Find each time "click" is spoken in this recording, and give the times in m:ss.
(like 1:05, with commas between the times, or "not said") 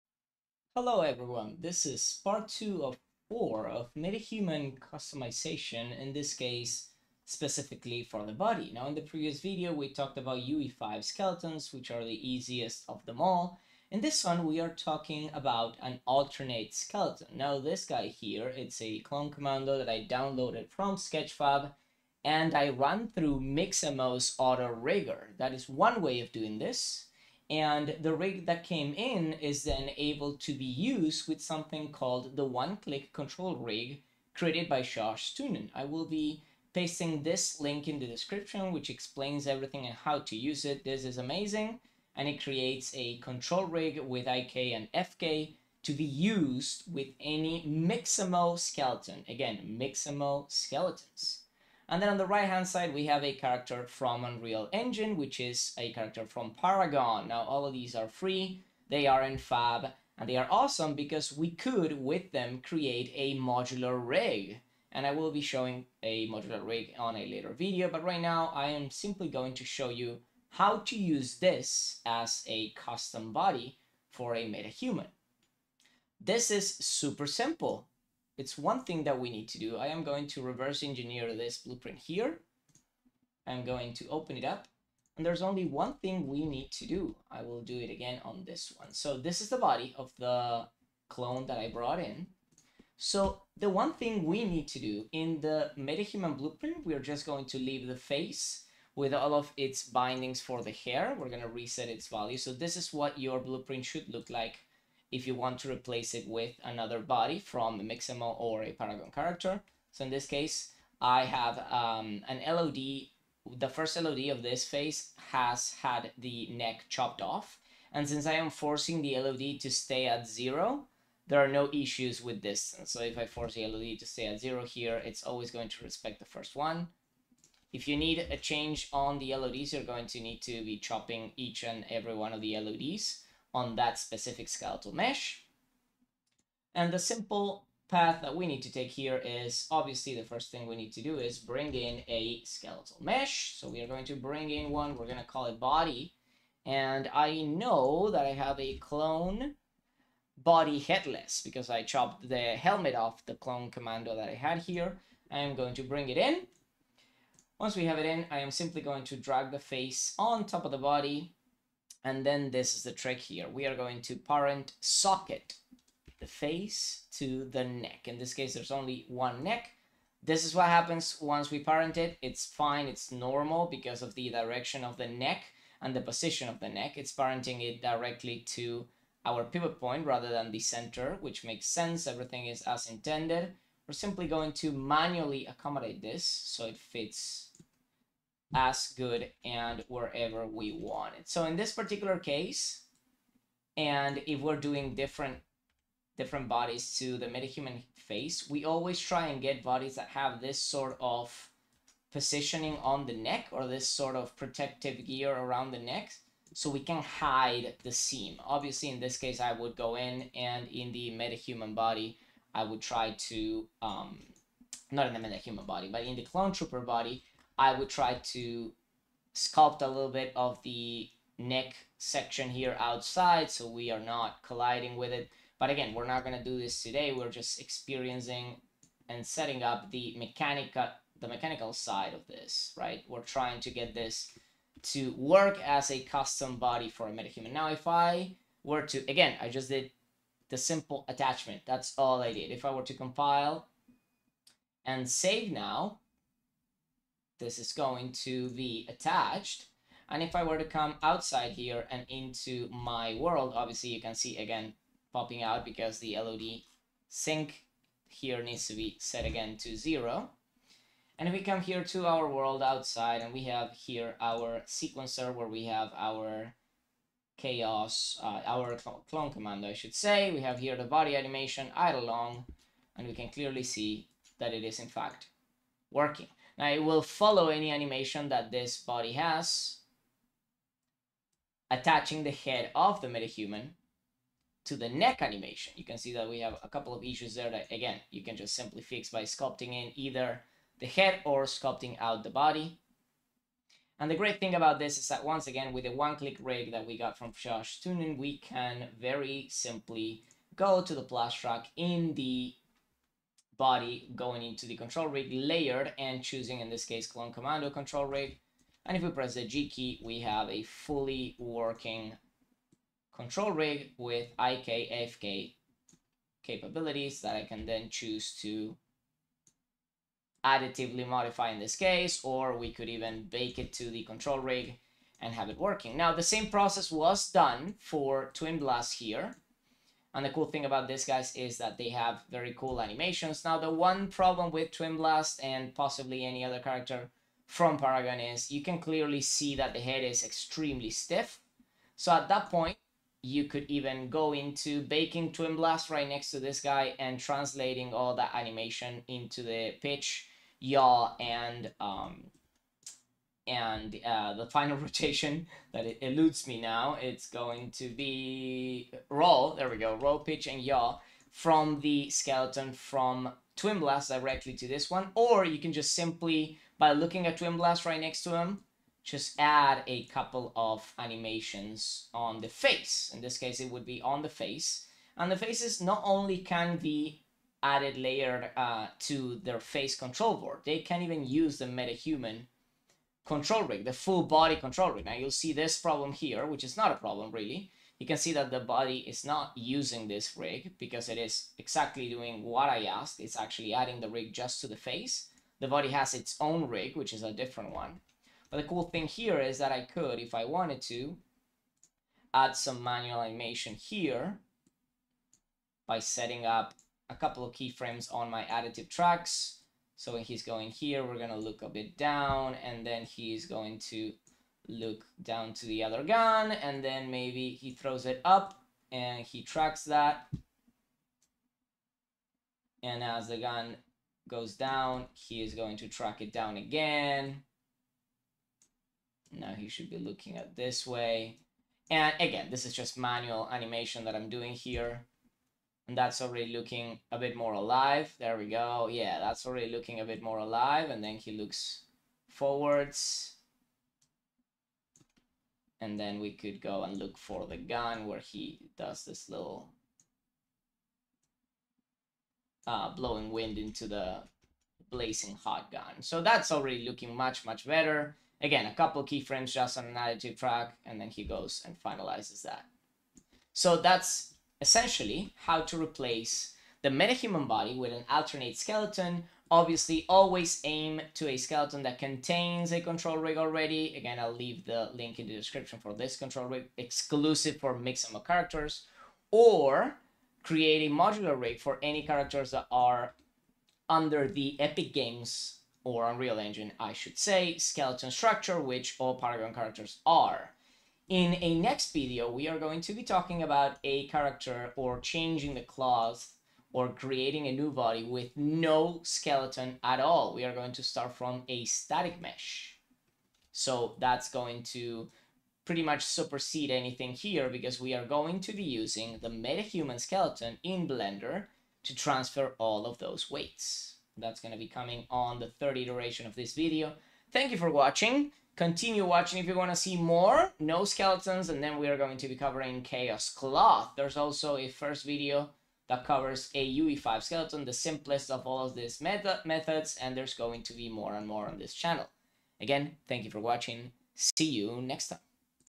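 0:32, 4:55.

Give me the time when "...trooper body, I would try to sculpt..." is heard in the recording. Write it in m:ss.
3:36.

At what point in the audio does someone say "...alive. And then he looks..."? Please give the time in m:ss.
7:20.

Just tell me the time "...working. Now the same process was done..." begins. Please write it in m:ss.
5:25.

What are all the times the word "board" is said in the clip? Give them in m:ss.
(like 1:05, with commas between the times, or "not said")
6:20.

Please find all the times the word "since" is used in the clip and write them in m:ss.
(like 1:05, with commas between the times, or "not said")
1:58.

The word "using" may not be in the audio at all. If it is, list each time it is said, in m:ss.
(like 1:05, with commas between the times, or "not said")
6:29, 8:28.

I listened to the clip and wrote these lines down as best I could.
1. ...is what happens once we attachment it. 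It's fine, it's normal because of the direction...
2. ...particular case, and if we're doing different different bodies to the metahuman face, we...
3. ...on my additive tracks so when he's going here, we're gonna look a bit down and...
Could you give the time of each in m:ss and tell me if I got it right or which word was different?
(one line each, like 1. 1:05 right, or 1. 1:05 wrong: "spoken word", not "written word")
1. 2:50 wrong: "parent", not "attachment"
2. 3:11 right
3. 6:48 right.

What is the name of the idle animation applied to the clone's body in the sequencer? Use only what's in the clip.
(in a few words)
idle long.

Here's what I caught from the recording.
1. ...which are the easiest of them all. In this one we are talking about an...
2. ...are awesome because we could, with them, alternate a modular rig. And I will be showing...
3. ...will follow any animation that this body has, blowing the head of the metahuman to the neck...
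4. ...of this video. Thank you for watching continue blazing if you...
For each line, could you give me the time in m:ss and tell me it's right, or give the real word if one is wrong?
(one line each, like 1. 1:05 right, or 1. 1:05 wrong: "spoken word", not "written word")
1. 0:11 right
2. 1:00 wrong: "create", not "alternate"
3. 4:36 wrong: "attaching", not "blowing"
4. 8:36 wrong: "watching", not "blazing".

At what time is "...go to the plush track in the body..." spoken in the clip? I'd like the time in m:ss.
5:00.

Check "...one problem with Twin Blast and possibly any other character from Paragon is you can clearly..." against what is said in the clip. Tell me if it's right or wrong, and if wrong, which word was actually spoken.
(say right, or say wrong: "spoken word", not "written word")
right.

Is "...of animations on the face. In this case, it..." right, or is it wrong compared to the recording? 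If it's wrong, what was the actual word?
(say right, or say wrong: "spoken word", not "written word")
right.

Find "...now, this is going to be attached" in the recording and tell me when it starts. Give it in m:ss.
4:05.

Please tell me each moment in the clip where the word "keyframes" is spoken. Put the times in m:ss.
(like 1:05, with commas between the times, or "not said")
6:47, 7:39.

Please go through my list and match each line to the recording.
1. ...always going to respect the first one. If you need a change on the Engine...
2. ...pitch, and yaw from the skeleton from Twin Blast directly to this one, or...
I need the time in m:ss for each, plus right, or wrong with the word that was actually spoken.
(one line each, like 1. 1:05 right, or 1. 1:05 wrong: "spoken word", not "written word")
1. 2:05 wrong: "LODs", not "Engine"
2. 6:00 right.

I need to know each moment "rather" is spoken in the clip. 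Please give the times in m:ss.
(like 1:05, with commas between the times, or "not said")
3:00.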